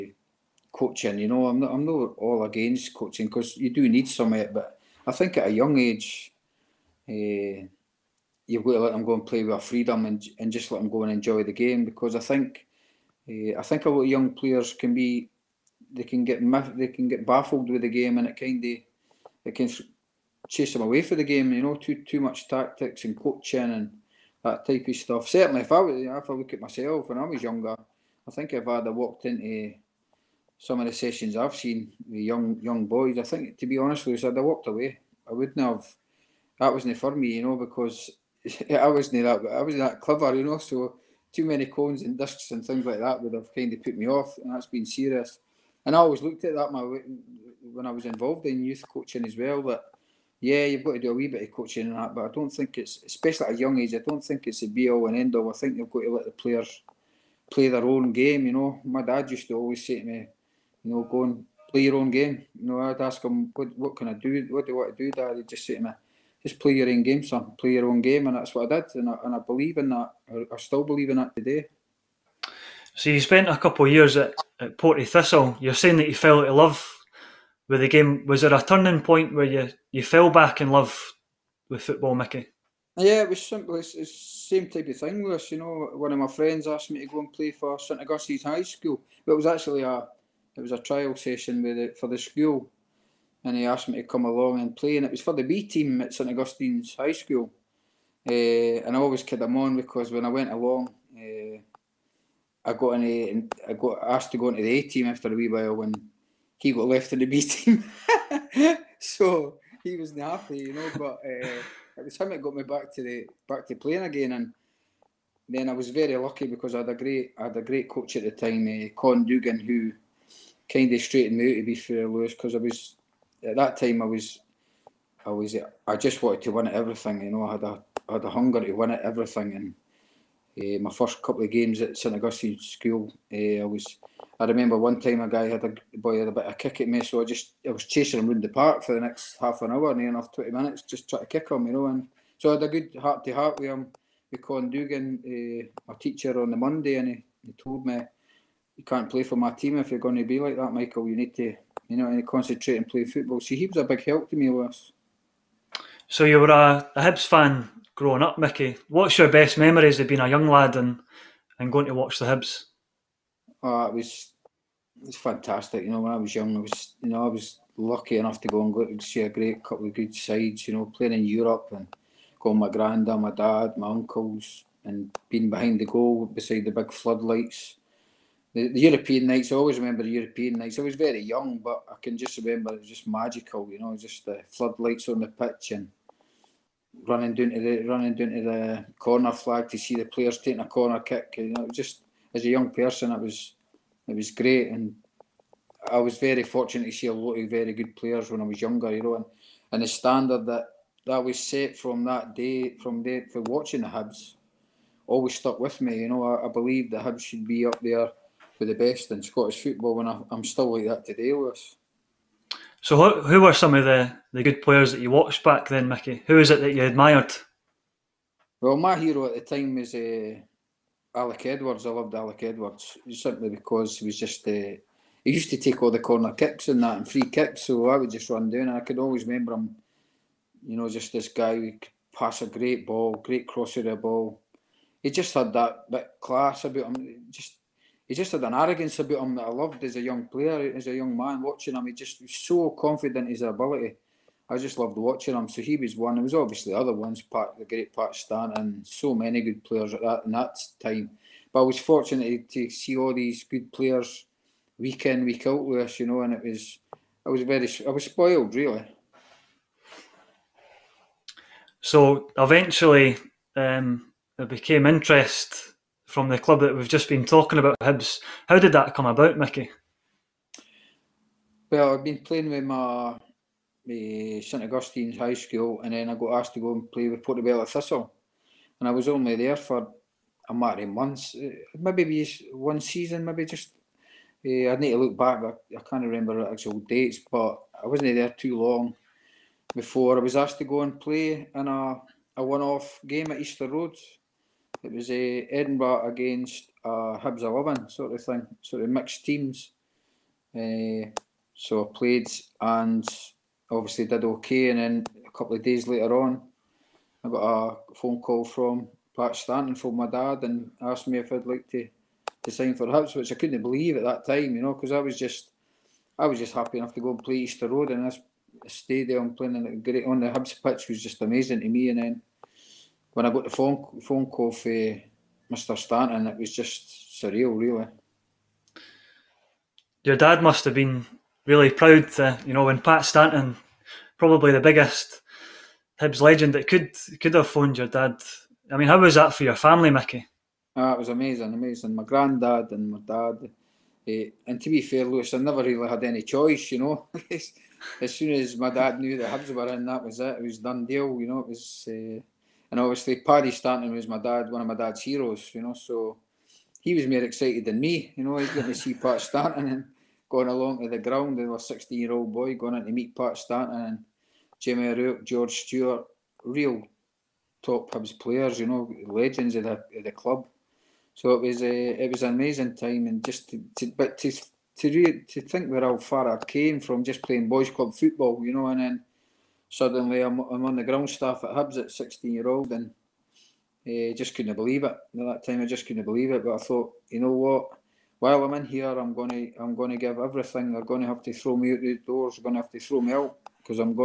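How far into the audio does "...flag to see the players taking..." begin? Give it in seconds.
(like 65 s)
189 s.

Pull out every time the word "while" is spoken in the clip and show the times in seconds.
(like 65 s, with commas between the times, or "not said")
105 s, 388 s.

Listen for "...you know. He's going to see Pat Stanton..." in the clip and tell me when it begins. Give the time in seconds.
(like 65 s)
358 s.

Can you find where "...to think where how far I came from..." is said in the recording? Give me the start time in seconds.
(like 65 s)
375 s.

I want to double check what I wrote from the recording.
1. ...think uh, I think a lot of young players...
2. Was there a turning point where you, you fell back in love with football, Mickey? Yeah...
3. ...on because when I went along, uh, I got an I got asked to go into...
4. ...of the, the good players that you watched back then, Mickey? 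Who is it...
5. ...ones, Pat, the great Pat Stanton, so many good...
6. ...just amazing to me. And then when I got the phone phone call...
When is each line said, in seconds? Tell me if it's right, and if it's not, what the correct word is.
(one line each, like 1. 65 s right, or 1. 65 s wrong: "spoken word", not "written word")
1. 12 s right
2. 78 s right
3. 99 s right
4. 213 s right
5. 246 s right
6. 321 s right.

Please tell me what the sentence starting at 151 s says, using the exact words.
You need to, you know, concentrate and play football." So he was a big help to me, was.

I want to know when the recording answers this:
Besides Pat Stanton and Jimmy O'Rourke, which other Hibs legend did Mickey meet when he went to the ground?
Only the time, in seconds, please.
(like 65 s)
365 s.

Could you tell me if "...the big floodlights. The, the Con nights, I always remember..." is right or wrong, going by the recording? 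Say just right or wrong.
wrong.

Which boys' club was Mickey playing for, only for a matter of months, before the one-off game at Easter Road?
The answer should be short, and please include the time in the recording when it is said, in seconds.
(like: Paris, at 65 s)
Portobello Thistle, at 277 s.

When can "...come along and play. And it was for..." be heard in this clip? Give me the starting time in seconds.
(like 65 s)
94 s.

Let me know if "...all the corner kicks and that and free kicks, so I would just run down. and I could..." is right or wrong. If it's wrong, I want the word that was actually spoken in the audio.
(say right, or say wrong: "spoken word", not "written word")
right.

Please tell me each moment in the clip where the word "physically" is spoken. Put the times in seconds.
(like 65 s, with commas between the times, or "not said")
not said.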